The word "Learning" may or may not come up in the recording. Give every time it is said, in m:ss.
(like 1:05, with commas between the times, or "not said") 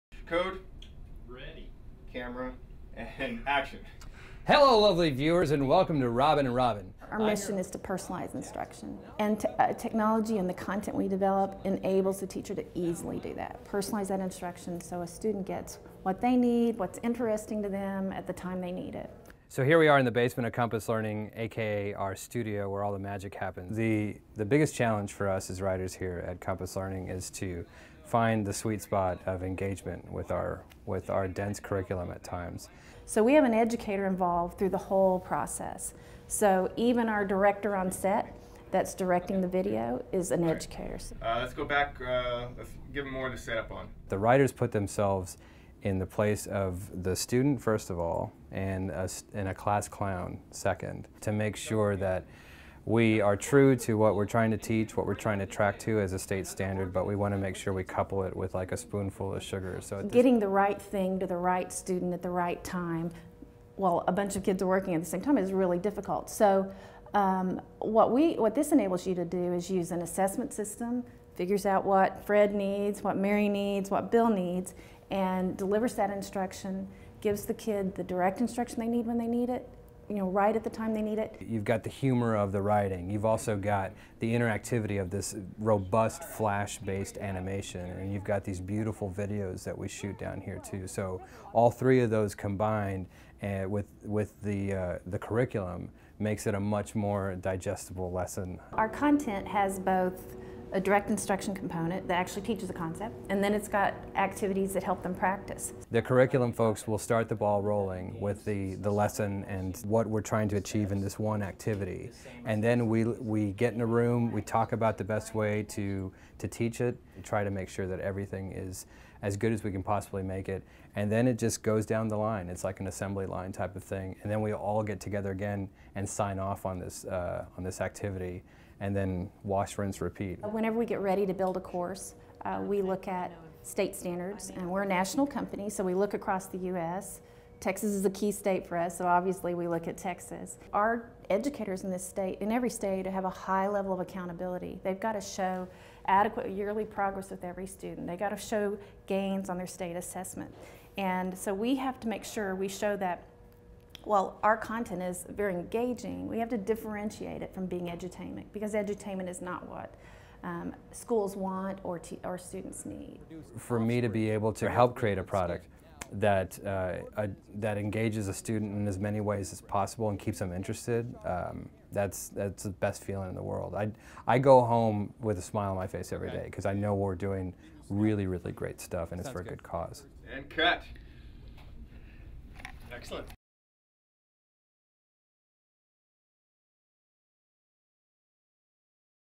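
0:20, 0:26.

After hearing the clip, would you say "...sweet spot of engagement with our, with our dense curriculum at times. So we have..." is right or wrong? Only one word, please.
right.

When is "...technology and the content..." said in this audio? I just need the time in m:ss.
0:09.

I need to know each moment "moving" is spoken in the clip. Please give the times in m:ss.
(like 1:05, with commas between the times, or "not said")
not said.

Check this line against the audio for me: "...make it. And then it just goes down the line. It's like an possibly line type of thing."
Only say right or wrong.
wrong.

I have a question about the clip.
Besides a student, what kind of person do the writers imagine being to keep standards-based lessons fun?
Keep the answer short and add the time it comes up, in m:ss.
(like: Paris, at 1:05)
a class clown, at 0:49.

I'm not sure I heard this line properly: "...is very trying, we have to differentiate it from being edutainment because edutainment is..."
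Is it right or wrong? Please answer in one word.
wrong.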